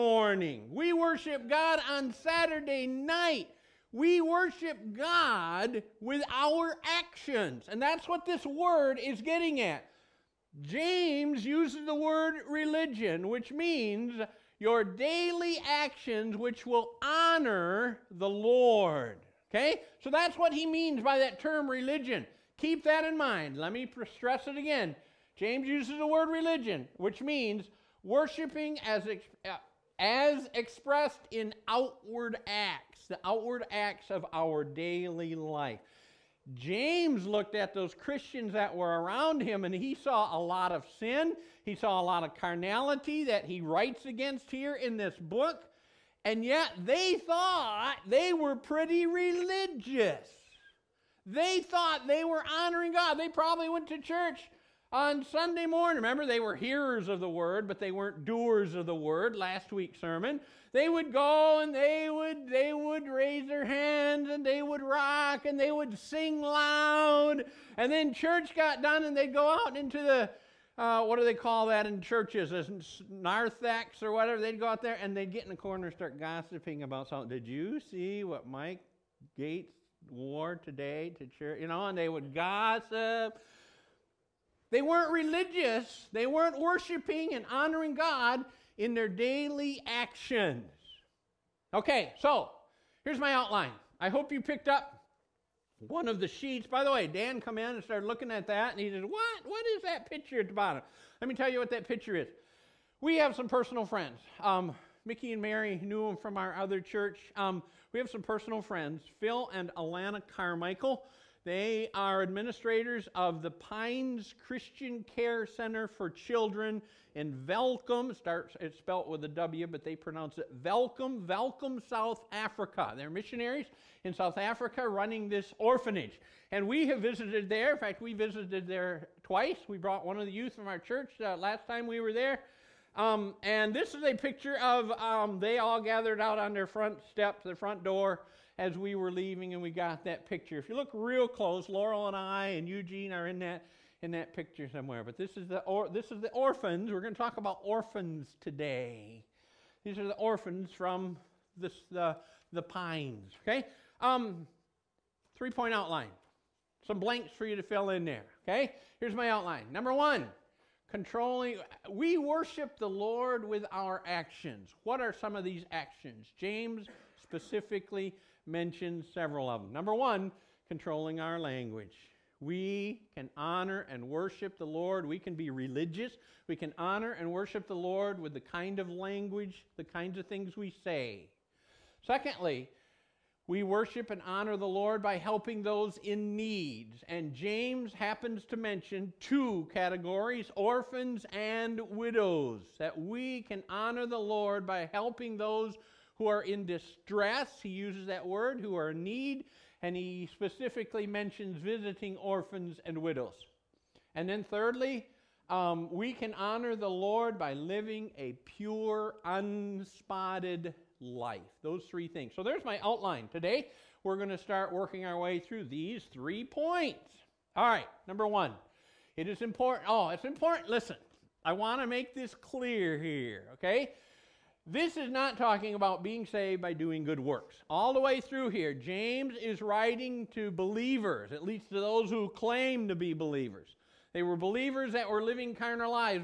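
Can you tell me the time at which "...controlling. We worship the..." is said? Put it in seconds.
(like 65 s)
160 s.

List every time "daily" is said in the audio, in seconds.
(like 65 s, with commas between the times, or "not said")
14 s, 34 s, 89 s.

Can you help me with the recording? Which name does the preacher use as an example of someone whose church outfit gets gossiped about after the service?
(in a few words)
Mike Gates.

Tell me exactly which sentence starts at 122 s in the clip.
They're missionaries in South Africa running this orphanage.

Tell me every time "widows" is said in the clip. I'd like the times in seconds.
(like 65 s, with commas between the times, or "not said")
191 s, 202 s.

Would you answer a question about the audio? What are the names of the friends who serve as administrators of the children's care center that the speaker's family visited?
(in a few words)
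Phil and Alana Carmichael.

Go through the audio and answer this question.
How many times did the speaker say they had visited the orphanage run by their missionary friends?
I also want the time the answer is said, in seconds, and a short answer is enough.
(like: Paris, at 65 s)
2, at 129 s.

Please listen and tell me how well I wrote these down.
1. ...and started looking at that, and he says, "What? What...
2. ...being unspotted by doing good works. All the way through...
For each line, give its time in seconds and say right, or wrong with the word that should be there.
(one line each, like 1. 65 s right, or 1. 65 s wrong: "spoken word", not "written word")
1. 97 s right
2. 226 s wrong: "saved", not "unspotted".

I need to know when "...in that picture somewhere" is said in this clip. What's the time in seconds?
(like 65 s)
144 s.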